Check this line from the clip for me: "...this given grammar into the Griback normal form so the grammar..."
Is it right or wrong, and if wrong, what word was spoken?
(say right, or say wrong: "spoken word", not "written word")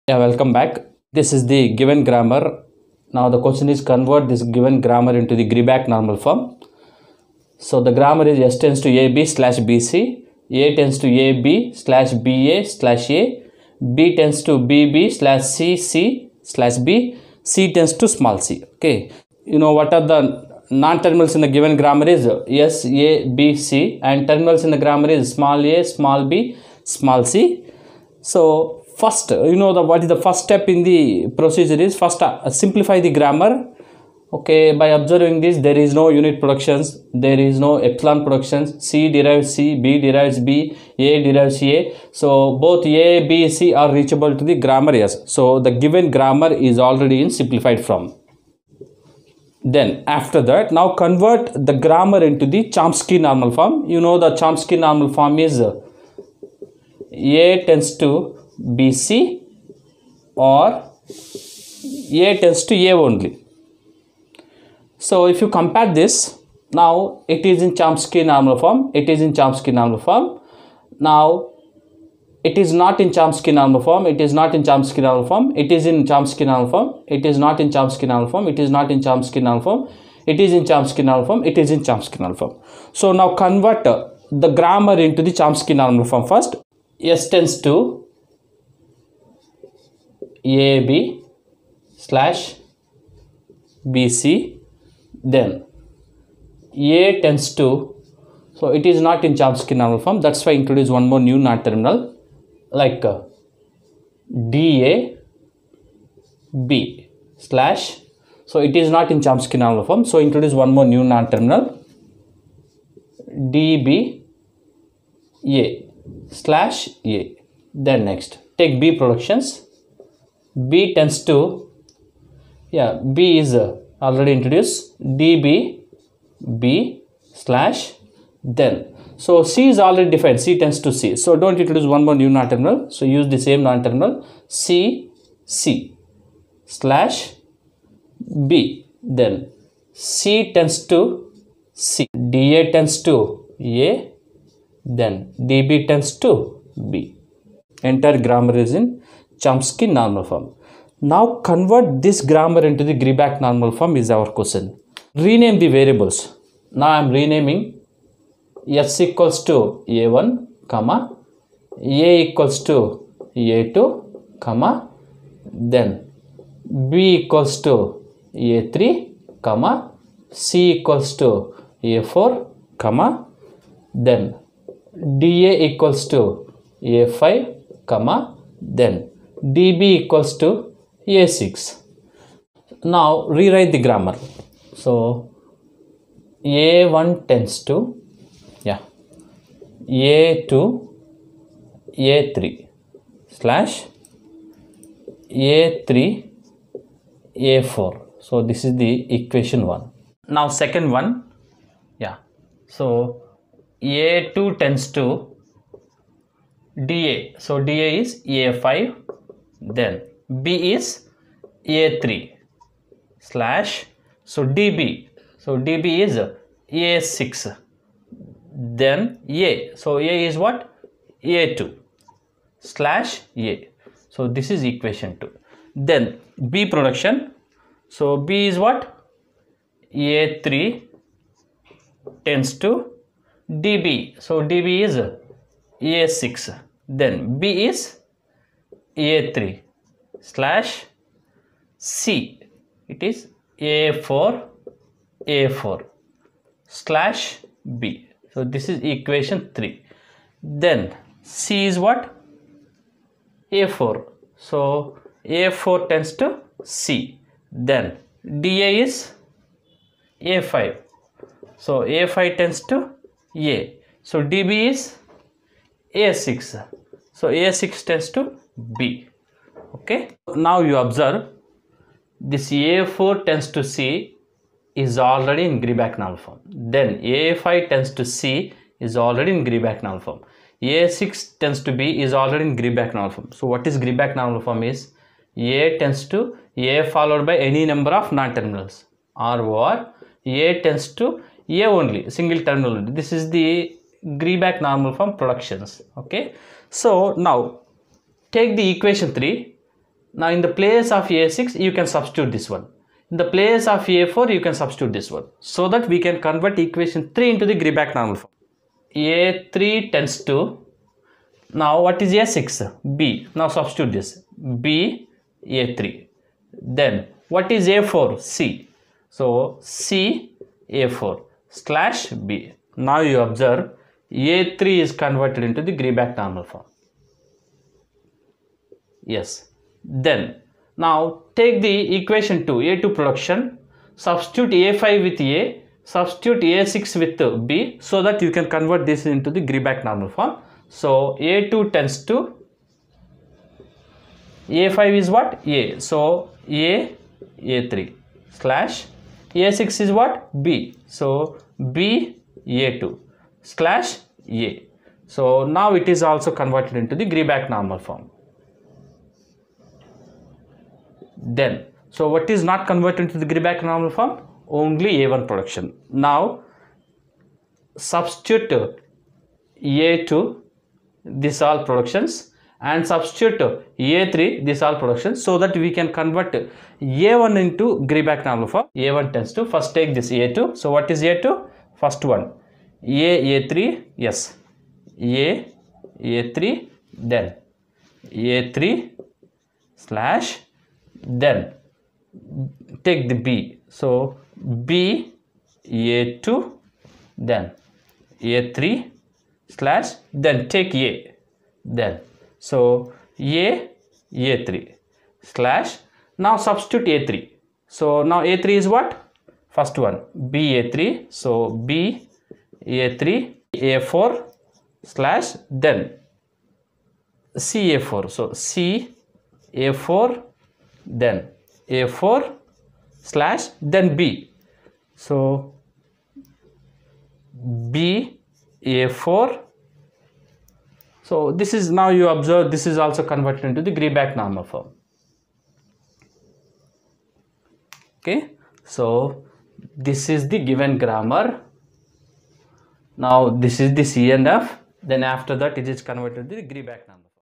wrong: "Greibach", not "Griback".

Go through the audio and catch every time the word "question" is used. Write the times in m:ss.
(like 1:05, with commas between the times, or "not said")
0:03, 2:34.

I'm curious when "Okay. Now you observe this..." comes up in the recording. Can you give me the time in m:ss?
4:29.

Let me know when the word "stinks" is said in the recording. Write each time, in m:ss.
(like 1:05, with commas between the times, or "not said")
not said.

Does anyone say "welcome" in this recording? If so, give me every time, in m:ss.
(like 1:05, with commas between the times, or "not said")
0:00.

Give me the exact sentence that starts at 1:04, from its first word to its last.
So if you compare this, now it is in Chomsky normal form, it is in Chomsky normal form.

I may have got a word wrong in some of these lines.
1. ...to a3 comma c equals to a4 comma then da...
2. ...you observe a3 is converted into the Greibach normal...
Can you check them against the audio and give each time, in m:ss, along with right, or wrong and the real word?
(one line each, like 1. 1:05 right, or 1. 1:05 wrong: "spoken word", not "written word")
1. 2:47 right
2. 5:23 right.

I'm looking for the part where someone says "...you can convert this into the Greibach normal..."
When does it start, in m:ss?
5:38.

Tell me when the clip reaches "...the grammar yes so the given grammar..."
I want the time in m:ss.
0:44.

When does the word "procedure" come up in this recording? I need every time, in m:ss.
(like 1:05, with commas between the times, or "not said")
0:31.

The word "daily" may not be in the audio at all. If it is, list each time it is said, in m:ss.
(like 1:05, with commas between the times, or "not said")
not said.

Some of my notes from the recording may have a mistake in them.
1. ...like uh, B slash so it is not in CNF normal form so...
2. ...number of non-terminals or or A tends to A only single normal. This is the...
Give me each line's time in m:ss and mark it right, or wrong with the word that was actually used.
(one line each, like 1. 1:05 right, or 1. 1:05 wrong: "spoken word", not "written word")
1. 1:42 wrong: "Chomsky", not "CNF"
2. 4:47 wrong: "terminal", not "normal".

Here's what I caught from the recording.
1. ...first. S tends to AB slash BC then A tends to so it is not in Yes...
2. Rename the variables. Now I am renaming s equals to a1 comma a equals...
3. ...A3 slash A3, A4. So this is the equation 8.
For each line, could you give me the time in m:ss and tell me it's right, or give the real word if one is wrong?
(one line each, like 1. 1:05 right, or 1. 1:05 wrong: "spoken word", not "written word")
1. 1:26 wrong: "Chomsky", not "Yes"
2. 2:35 right
3. 3:11 wrong: "1", not "8".